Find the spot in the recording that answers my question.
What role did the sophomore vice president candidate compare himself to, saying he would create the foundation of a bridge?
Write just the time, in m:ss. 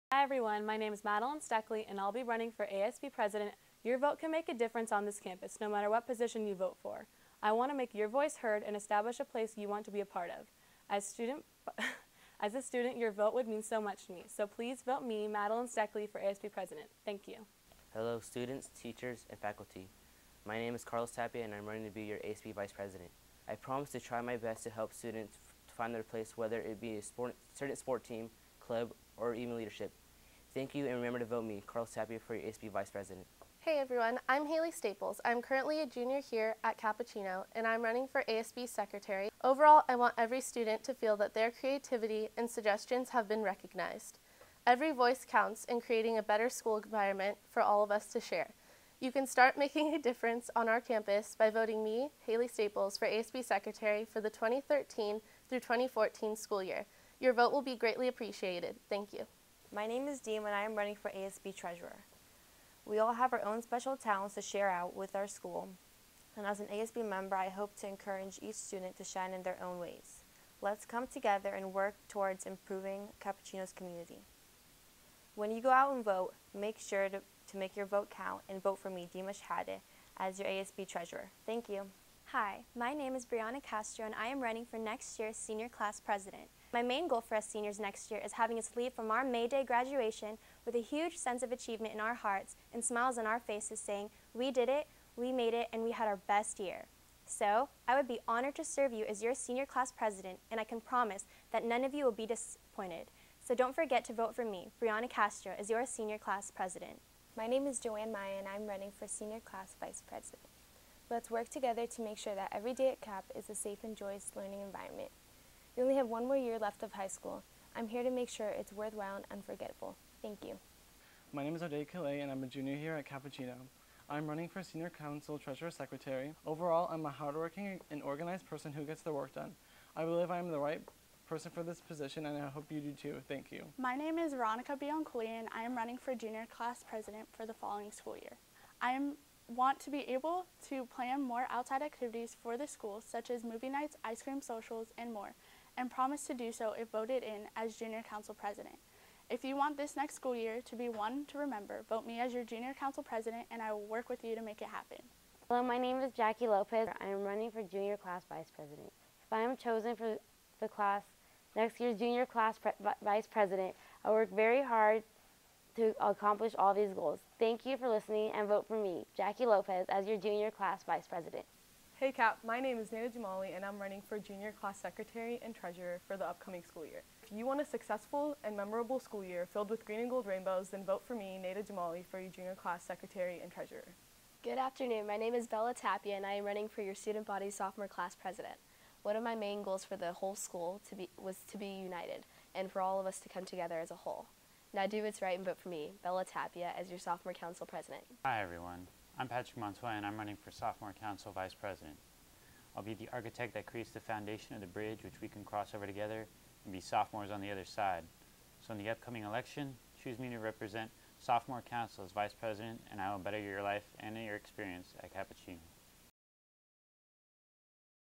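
3:23.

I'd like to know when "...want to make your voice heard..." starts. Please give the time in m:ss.
0:07.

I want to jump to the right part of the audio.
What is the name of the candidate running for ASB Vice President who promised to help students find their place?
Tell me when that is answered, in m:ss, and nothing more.
0:20.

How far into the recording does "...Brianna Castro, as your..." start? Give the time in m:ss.
1:44.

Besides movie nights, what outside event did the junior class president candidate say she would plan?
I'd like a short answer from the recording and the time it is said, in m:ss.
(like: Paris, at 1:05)
ice cream socials, at 2:24.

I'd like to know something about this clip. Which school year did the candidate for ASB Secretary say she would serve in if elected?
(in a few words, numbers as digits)
2013 through 2014.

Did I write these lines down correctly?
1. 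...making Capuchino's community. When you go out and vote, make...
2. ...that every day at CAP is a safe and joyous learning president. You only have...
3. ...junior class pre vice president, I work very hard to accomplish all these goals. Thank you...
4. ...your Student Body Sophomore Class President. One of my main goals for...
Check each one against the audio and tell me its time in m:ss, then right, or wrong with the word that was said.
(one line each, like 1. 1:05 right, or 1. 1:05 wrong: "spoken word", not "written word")
1. 1:12 wrong: "improving", not "making"
2. 1:52 wrong: "environment", not "president"
3. 2:41 right
4. 3:06 right.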